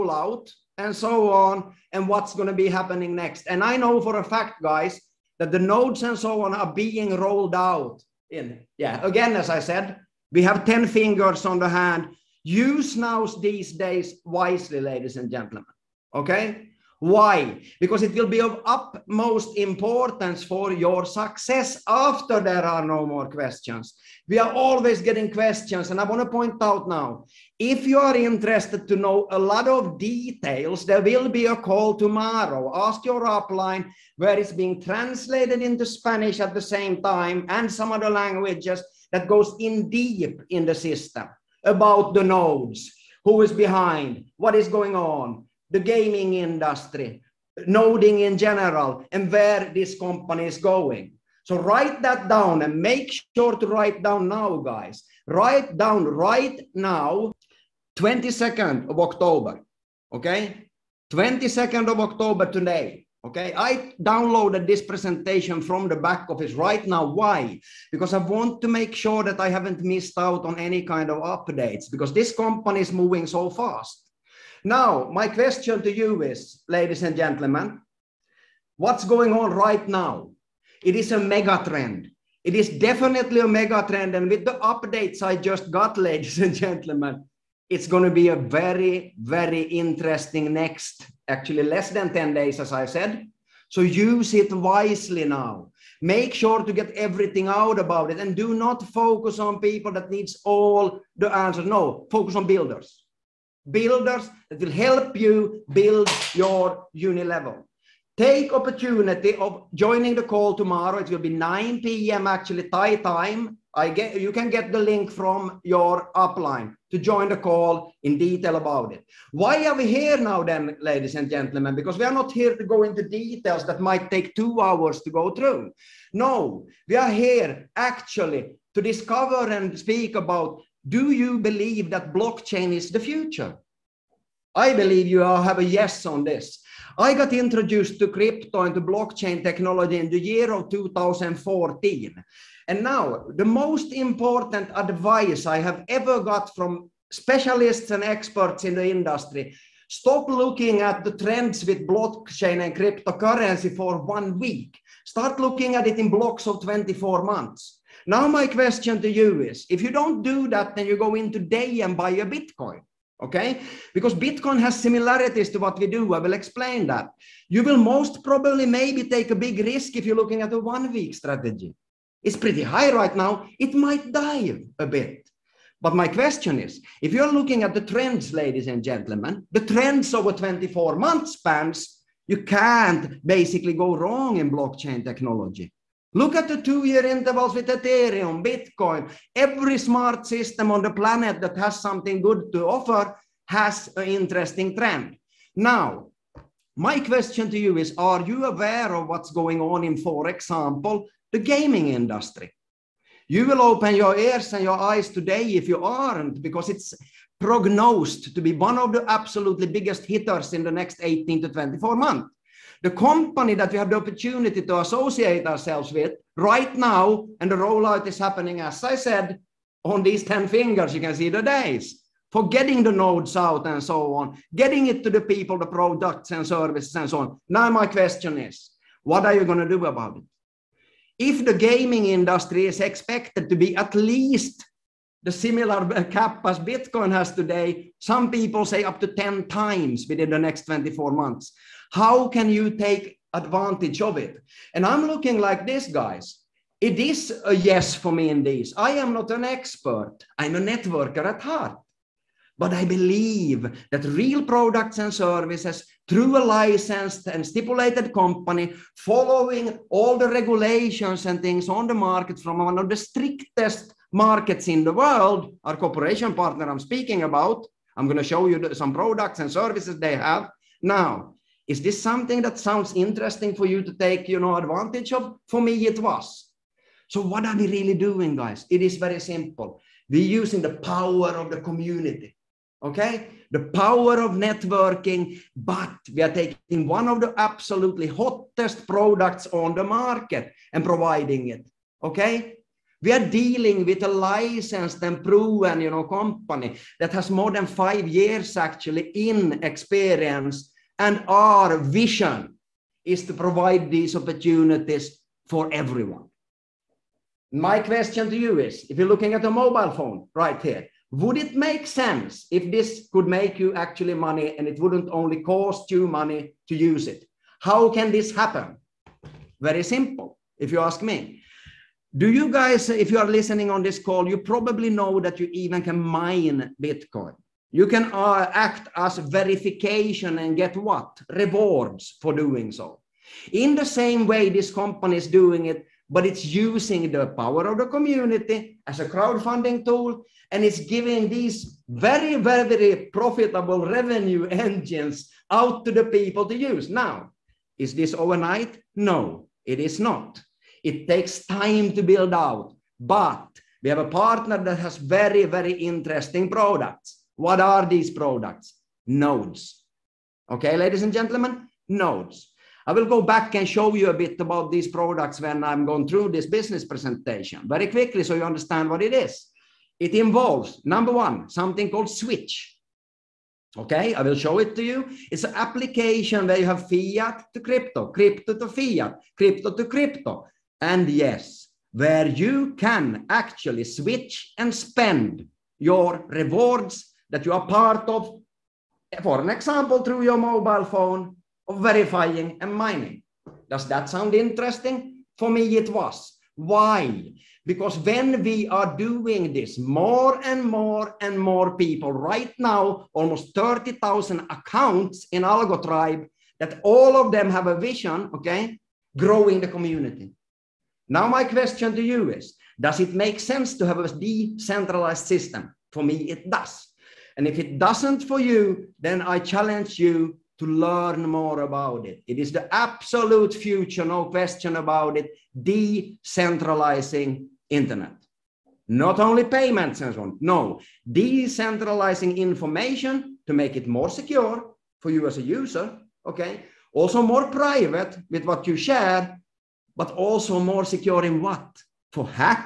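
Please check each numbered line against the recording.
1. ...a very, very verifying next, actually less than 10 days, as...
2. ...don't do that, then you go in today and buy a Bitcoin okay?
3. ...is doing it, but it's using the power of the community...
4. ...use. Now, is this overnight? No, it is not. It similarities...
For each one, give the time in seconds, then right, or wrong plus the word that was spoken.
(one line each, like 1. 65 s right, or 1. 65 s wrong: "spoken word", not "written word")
1. 88 s wrong: "interesting", not "verifying"
2. 159 s right
3. 335 s right
4. 346 s wrong: "takes", not "similarities".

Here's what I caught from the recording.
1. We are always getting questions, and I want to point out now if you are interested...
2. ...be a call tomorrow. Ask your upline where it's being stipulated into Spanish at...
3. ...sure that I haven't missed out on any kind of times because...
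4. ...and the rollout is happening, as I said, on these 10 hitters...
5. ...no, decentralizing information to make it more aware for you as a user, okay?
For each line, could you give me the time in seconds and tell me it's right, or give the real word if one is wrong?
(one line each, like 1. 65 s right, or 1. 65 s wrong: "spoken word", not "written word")
1. 24 s right
2. 31 s wrong: "translated", not "stipulated"
3. 68 s wrong: "updates", not "times"
4. 217 s wrong: "fingers", not "hitters"
5. 430 s wrong: "secure", not "aware".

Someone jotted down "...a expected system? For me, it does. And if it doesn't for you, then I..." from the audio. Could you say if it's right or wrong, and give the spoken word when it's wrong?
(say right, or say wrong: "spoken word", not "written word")
wrong: "decentralized", not "expected".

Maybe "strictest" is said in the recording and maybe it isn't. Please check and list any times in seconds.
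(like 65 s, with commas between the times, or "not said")
262 s.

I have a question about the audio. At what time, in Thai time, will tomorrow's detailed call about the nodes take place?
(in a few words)
9 p.m.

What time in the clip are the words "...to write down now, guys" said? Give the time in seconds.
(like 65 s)
53 s.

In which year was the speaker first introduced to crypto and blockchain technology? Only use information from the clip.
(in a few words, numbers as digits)
2014.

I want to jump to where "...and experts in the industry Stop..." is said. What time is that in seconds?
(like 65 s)
147 s.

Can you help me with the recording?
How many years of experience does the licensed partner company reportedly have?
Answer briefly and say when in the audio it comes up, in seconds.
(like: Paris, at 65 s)
more than 5 years, at 297 s.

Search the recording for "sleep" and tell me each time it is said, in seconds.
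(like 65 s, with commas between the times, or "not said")
not said.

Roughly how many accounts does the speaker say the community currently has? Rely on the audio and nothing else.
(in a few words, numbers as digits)
almost 30,000.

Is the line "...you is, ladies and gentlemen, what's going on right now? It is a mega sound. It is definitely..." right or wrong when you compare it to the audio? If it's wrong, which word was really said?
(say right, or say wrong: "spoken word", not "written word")
wrong: "trend", not "sound".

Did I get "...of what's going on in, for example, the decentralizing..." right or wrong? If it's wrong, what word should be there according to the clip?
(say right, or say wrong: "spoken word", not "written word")
wrong: "gaming", not "decentralizing".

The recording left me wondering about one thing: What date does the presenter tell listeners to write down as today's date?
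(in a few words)
22nd of October.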